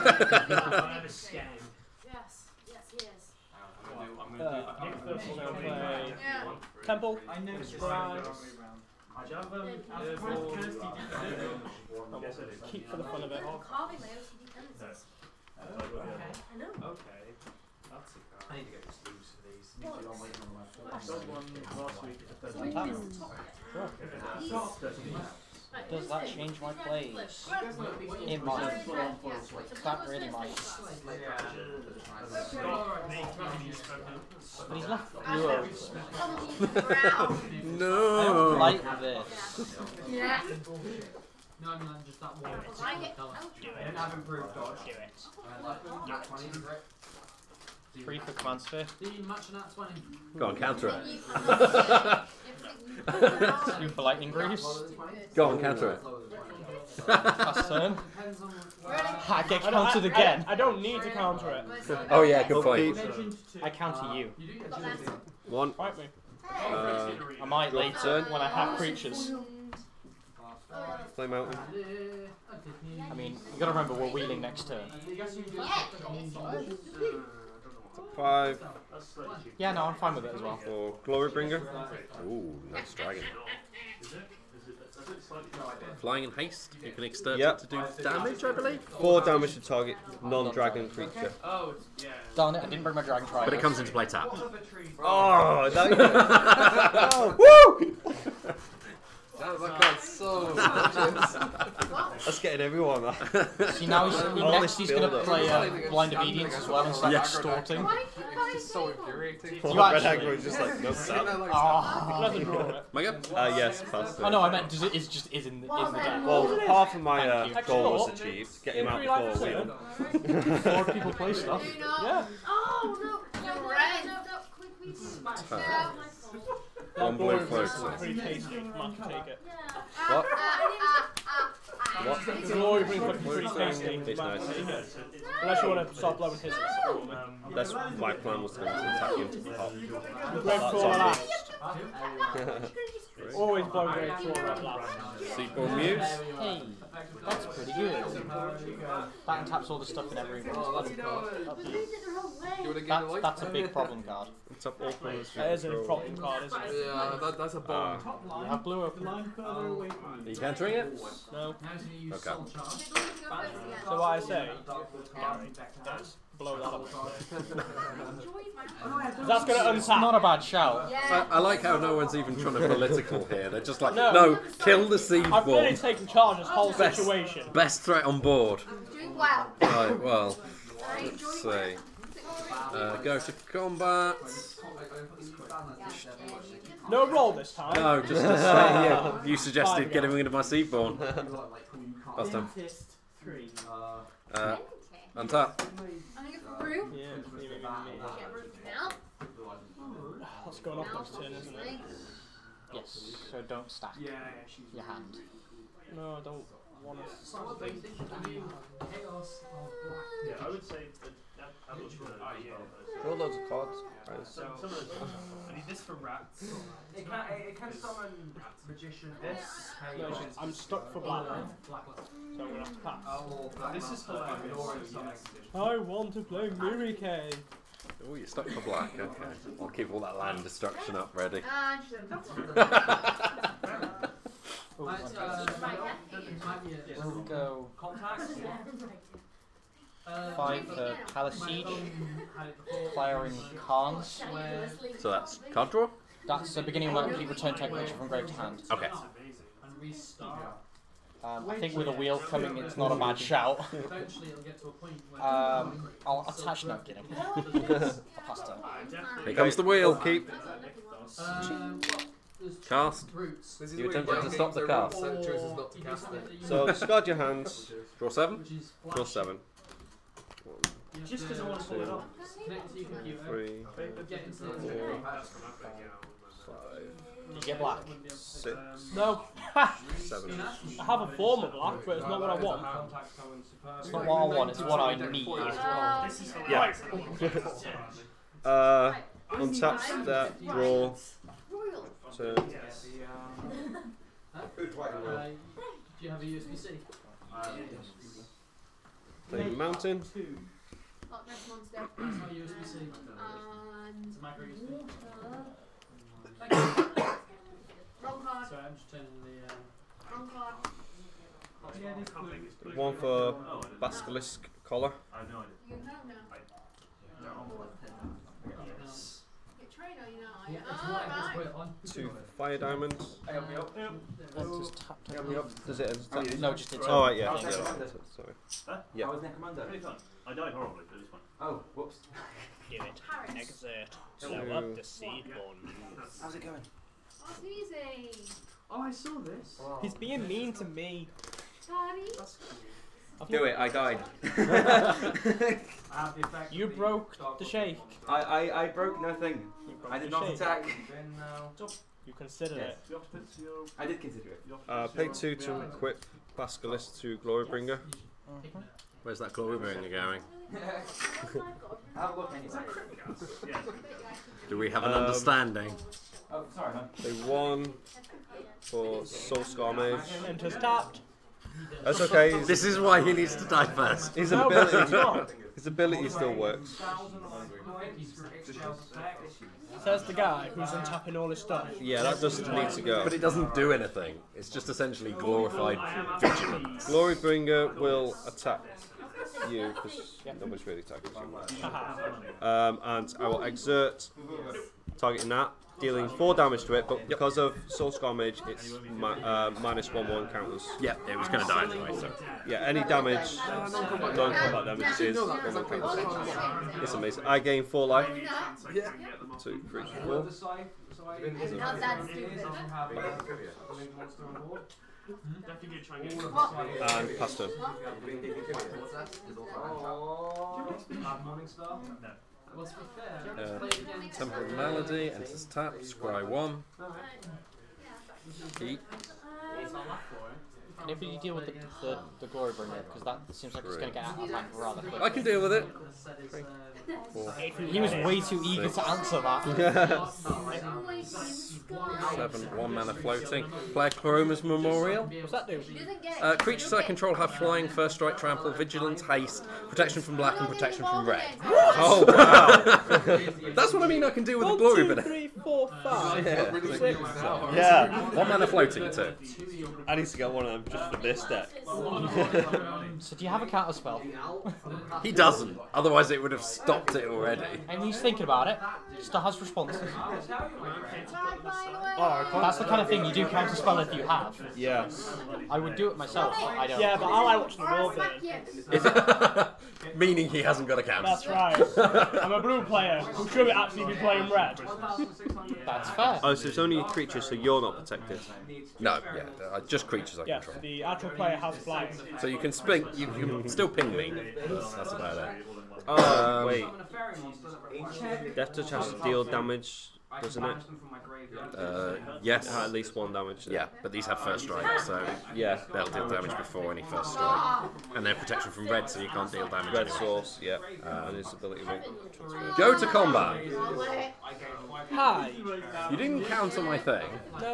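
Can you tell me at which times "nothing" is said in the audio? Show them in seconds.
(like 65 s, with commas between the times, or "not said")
349 s.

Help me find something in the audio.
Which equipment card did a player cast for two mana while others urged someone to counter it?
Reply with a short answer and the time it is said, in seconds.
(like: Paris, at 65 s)
Lightning Greaves, at 54 s.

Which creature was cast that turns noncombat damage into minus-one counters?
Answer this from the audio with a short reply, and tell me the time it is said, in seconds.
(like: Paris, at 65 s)
Soul Scar Mage, at 369 s.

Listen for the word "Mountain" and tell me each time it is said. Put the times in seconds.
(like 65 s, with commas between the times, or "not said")
71 s, 299 s.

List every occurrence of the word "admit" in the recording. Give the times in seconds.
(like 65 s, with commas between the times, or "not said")
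not said.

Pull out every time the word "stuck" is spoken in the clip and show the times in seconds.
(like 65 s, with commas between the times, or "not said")
220 s, 228 s.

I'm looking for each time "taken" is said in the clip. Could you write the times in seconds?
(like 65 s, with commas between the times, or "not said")
175 s.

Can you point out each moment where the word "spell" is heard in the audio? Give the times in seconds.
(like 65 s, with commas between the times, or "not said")
463 s, 473 s.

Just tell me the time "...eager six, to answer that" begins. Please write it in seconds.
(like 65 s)
438 s.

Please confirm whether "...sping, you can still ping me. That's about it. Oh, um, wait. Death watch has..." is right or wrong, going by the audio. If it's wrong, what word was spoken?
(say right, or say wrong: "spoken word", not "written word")
wrong: "touch", not "watch".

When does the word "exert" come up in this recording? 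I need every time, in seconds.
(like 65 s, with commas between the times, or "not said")
333 s, 393 s.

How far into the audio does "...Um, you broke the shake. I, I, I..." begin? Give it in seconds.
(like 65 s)
345 s.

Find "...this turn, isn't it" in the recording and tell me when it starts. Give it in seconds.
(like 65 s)
201 s.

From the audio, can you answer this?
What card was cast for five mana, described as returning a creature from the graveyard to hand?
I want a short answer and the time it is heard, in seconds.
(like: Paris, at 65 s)
Palace Siege, at 241 s.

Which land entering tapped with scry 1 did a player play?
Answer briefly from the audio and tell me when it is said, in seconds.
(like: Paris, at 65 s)
Temple of Malady, at 424 s.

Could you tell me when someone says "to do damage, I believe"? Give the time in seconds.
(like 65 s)
87 s.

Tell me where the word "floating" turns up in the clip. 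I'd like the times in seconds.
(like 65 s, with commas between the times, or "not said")
442 s, 458 s.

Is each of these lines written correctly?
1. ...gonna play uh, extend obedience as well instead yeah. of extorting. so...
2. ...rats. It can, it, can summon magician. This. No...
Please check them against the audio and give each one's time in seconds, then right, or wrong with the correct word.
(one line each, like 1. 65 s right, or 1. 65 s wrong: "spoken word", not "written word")
1. 104 s wrong: "blind", not "extend"
2. 215 s right.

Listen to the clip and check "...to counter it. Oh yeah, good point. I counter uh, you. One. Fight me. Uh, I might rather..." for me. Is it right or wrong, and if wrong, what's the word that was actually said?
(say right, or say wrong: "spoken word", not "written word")
wrong: "later", not "rather".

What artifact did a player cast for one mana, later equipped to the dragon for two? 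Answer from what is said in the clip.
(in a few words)
Basilisk Collar.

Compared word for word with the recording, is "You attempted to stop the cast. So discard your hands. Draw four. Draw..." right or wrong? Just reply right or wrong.
wrong.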